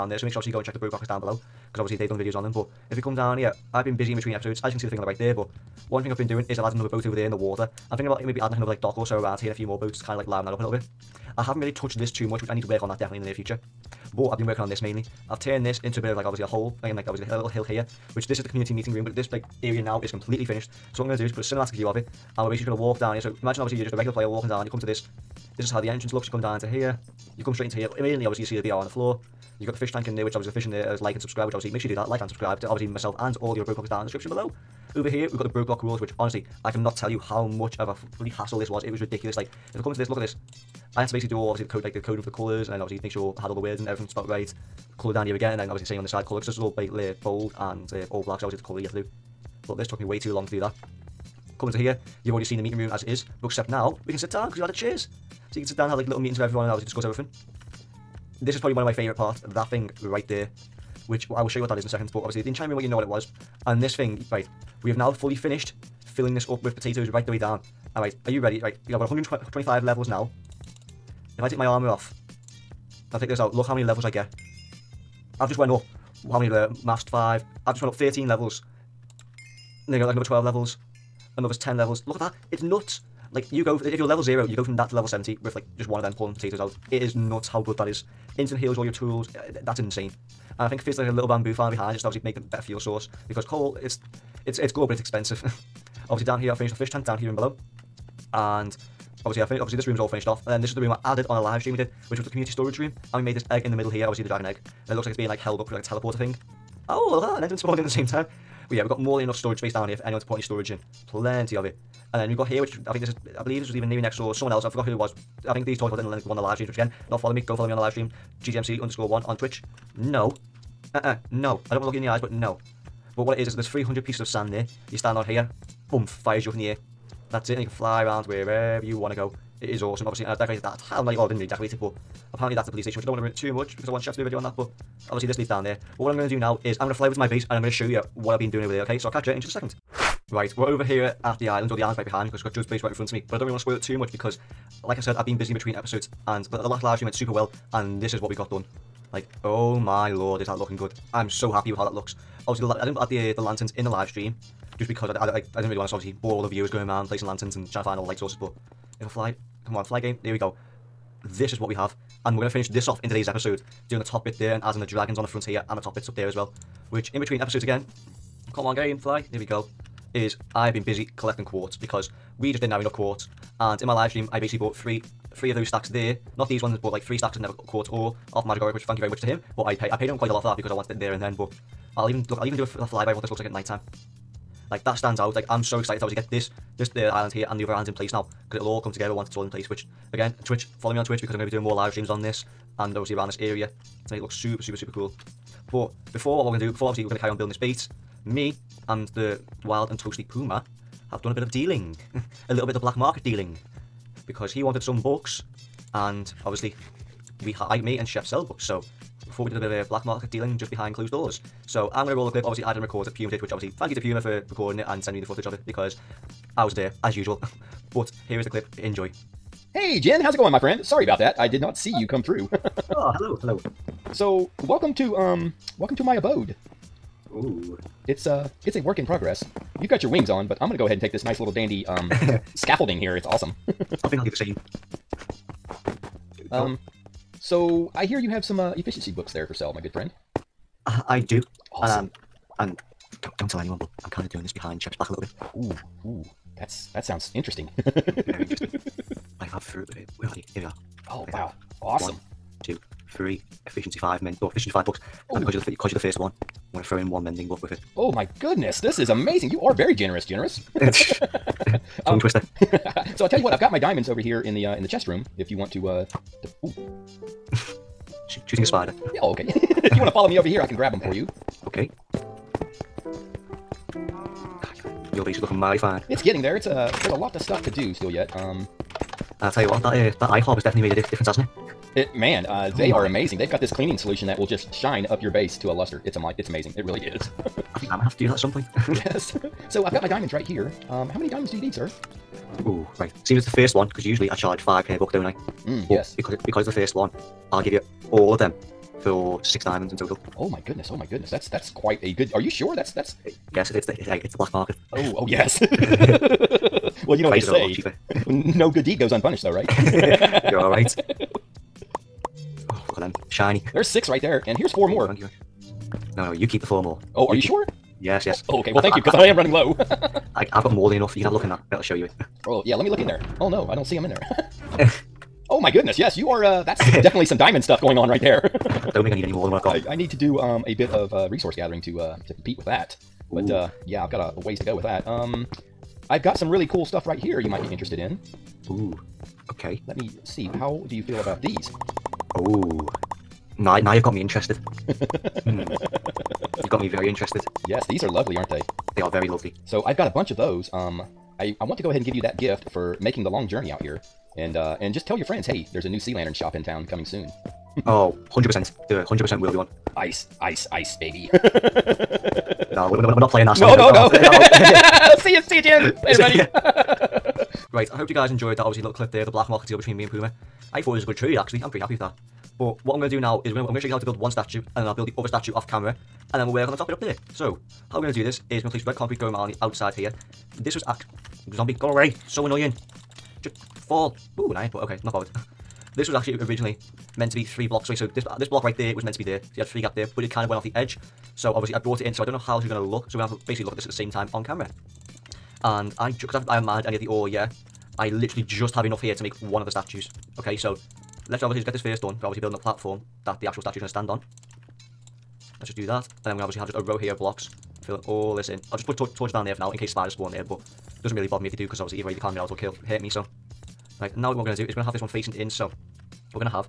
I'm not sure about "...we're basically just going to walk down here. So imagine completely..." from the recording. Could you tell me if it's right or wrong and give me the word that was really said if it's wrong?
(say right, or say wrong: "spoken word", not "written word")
wrong: "obviously", not "completely".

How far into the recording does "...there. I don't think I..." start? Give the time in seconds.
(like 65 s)
328 s.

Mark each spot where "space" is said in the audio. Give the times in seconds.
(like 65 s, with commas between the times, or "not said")
109 s.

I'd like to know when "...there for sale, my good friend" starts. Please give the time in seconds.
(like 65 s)
239 s.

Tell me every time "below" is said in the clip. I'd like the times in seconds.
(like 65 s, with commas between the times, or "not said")
1 s, 34 s, 97 s.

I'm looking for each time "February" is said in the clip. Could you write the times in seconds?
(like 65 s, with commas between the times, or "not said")
not said.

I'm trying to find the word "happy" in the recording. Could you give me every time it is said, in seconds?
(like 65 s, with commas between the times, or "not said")
151 s, 371 s.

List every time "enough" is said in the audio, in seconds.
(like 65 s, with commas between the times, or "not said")
109 s, 172 s, 320 s, 398 s.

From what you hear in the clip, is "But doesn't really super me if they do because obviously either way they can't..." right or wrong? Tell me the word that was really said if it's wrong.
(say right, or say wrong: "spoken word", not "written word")
wrong: "bother", not "super".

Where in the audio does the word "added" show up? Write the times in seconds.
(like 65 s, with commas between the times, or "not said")
6 s, 101 s.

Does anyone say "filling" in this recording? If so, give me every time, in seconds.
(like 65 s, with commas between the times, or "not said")
66 s, 407 s.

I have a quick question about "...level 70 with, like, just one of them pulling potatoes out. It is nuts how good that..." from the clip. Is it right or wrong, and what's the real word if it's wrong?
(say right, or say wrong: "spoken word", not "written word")
right.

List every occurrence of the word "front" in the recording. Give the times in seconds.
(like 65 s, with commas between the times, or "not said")
142 s, 165 s.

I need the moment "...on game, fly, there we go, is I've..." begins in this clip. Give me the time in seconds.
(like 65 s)
168 s.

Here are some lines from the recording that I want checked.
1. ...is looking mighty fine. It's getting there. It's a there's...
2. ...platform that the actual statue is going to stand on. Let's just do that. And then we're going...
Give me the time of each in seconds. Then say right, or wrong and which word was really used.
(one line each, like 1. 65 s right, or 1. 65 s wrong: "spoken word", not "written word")
1. 275 s right
2. 402 s right.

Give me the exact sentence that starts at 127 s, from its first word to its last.
That's it, and you can fly around wherever you want to go.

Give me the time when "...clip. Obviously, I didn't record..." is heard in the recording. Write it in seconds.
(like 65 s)
212 s.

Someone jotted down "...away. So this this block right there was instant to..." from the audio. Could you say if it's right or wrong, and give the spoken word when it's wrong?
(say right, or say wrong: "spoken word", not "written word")
wrong: "meant", not "instant".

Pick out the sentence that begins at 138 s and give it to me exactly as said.
So I'll catch you in just a second.